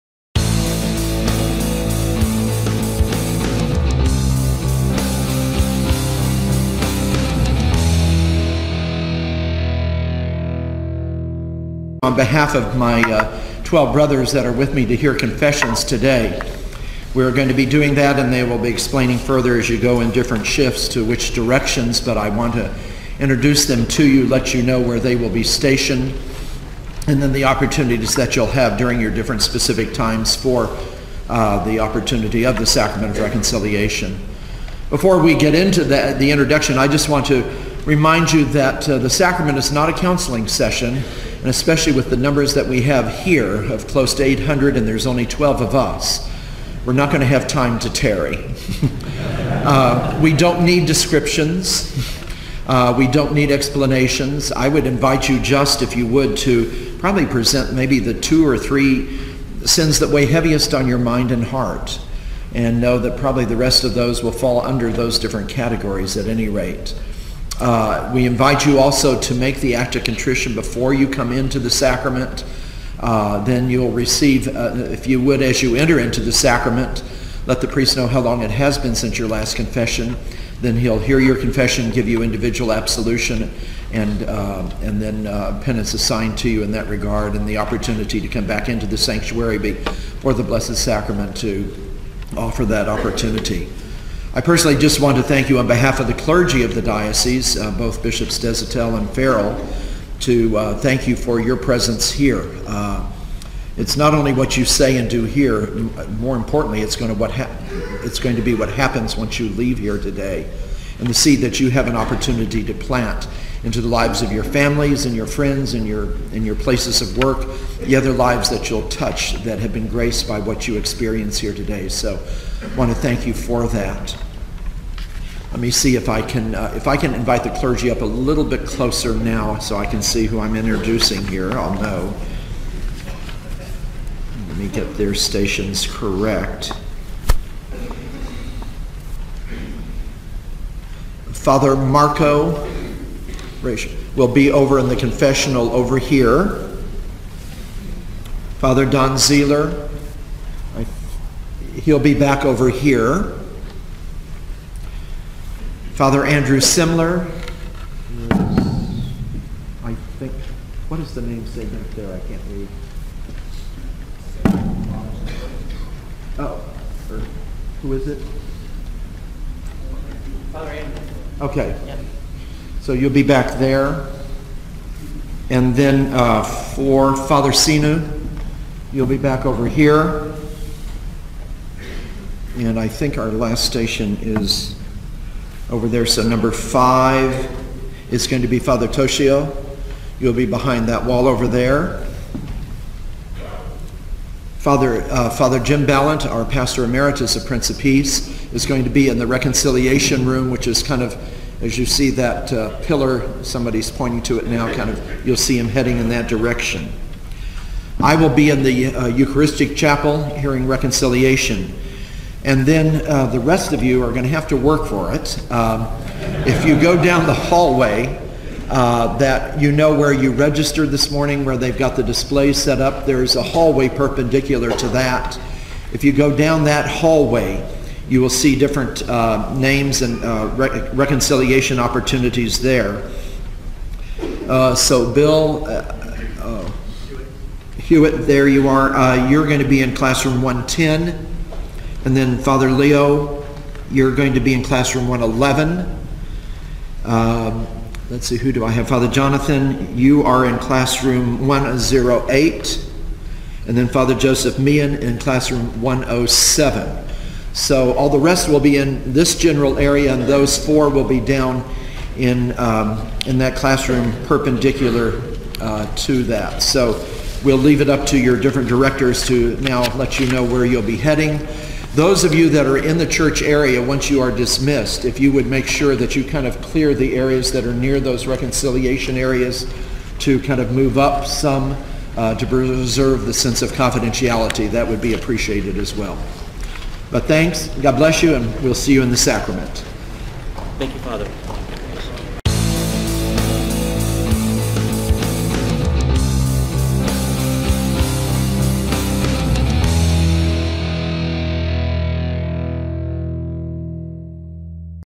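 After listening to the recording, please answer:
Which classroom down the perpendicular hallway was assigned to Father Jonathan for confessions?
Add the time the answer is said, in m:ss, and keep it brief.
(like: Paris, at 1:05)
Classroom 108, at 4:10.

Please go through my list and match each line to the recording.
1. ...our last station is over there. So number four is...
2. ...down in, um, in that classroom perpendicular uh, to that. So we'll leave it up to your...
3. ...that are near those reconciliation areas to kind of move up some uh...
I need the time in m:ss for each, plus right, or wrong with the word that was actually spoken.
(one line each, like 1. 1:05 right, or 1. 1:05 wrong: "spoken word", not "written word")
1. 3:03 wrong: "five", not "four"
2. 4:21 right
3. 4:37 right.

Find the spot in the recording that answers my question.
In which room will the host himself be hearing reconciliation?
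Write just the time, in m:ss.
3:29.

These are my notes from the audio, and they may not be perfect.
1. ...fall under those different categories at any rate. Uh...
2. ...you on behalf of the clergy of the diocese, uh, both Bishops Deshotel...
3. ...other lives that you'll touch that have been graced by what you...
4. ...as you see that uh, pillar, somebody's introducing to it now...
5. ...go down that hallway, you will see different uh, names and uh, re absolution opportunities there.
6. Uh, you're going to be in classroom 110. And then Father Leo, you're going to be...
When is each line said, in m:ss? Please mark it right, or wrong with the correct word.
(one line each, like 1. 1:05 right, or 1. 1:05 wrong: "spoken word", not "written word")
1. 1:04 right
2. 1:35 right
3. 1:57 right
4. 3:21 wrong: "pointing", not "introducing"
5. 3:46 wrong: "reconciliation", not "absolution"
6. 3:58 right.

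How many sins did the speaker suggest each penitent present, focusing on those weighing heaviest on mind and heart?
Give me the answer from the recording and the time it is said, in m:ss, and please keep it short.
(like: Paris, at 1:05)
2 or 3, at 0:58.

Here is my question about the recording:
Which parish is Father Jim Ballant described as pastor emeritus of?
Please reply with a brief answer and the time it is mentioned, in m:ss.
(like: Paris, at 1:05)
Prince of Peace, at 3:17.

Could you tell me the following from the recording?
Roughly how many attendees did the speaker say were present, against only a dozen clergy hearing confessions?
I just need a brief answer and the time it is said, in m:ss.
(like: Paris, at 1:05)
800, at 0:43.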